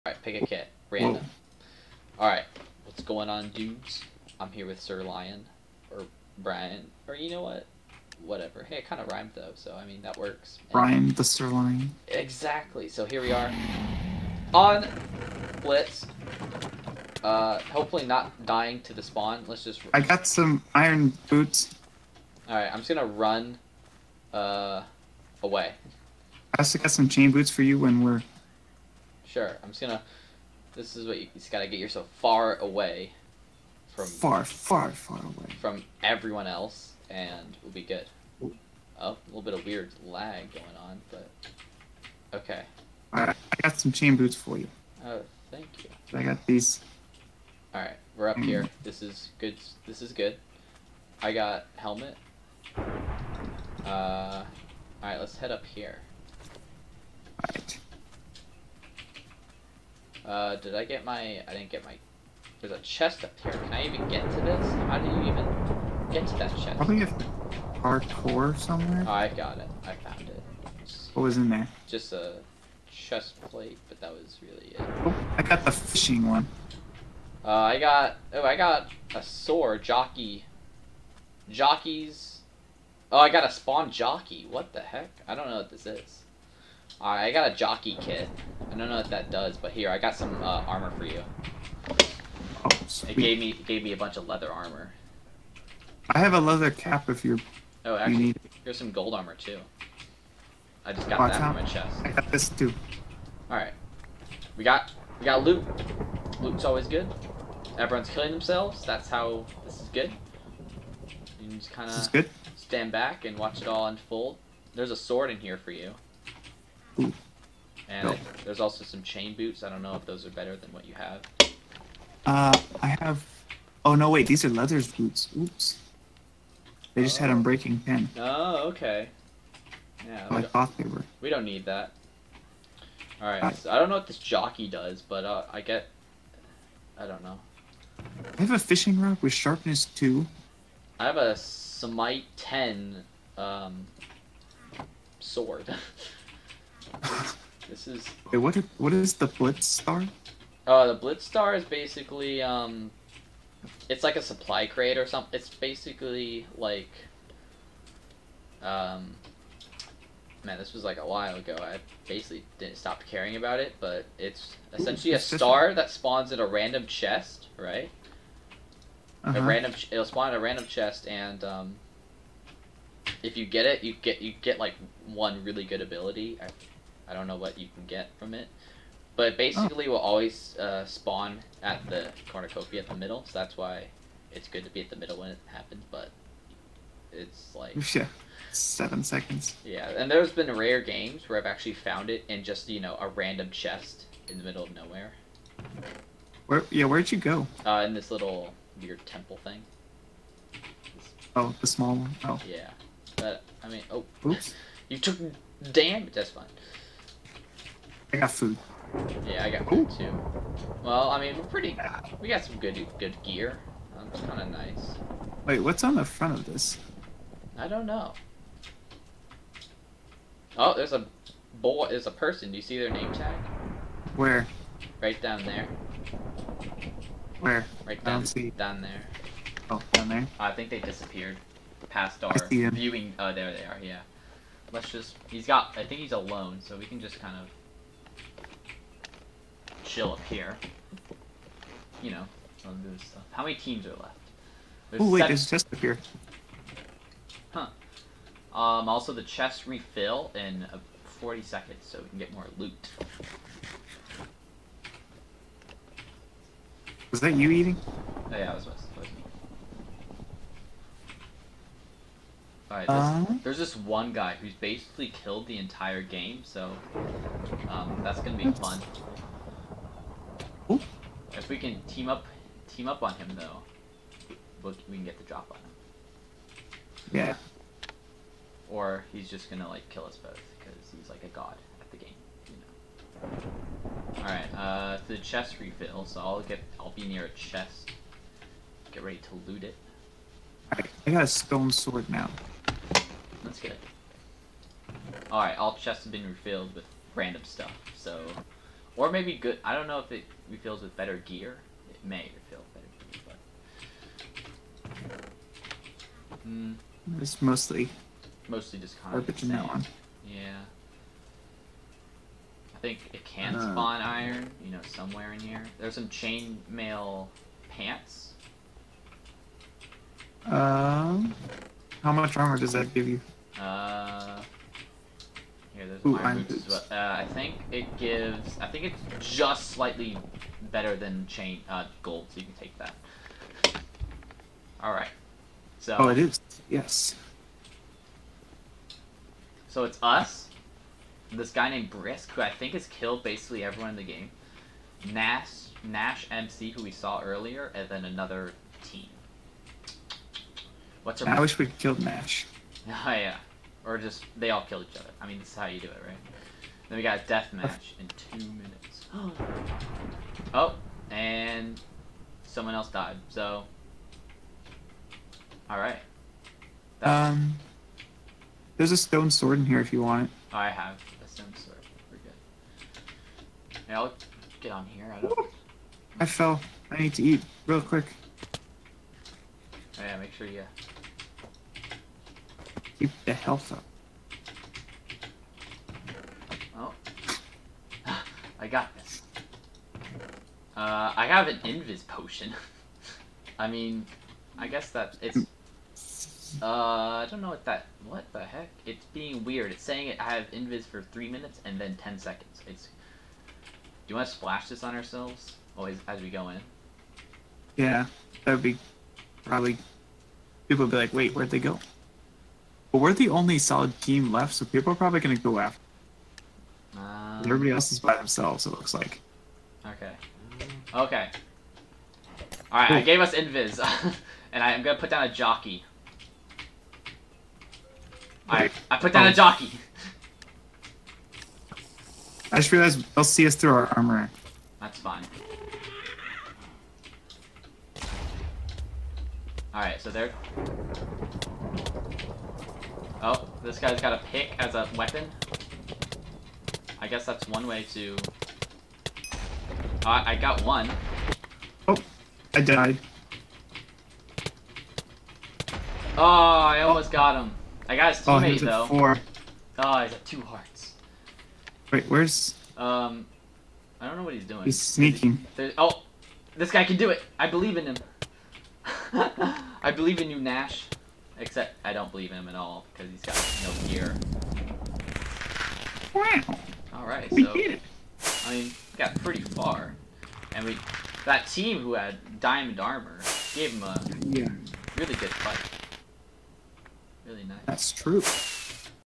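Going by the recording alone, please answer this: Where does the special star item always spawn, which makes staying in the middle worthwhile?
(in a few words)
the cornucopia.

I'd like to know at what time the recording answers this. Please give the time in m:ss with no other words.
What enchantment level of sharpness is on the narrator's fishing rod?
2:19.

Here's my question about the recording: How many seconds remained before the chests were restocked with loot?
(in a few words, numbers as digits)
40.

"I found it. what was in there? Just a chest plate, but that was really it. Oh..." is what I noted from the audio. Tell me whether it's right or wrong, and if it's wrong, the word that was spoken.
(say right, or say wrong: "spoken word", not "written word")
right.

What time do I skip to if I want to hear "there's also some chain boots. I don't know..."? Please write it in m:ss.
1:58.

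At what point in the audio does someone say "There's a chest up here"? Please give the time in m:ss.
1:02.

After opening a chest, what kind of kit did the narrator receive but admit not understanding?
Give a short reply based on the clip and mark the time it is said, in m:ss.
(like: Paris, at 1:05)
jockey kit, at 1:27.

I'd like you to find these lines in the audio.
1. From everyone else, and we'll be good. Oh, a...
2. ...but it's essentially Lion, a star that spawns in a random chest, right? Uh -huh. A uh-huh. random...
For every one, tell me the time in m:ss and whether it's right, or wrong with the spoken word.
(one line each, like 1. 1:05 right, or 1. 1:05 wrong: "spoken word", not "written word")
1. 0:35 right
2. 2:43 wrong: "Ooh", not "Lion".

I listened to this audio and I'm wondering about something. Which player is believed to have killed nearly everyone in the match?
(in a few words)
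Brisk.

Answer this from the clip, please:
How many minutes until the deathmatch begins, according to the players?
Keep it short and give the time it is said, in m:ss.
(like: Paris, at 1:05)
2, at 5:58.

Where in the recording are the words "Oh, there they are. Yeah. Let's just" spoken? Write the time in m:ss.
3:53.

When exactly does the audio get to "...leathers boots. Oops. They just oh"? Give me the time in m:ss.
2:04.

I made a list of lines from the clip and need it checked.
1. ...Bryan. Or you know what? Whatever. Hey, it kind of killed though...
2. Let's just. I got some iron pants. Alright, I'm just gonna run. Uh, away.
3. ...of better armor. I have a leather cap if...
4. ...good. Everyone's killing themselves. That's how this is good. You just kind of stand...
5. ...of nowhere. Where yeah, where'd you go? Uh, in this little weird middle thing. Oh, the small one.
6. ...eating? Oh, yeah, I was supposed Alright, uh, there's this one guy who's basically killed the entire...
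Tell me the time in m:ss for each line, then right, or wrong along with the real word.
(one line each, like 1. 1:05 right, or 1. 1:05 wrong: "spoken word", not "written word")
1. 0:06 wrong: "rhymed", not "killed"
2. 0:19 wrong: "boots", not "pants"
3. 1:34 wrong: "leather", not "better"
4. 1:46 right
5. 3:14 wrong: "temple", not "middle"
6. 4:17 right.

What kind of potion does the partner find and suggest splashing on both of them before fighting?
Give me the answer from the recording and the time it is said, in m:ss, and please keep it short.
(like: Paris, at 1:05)
invis potion, at 6:31.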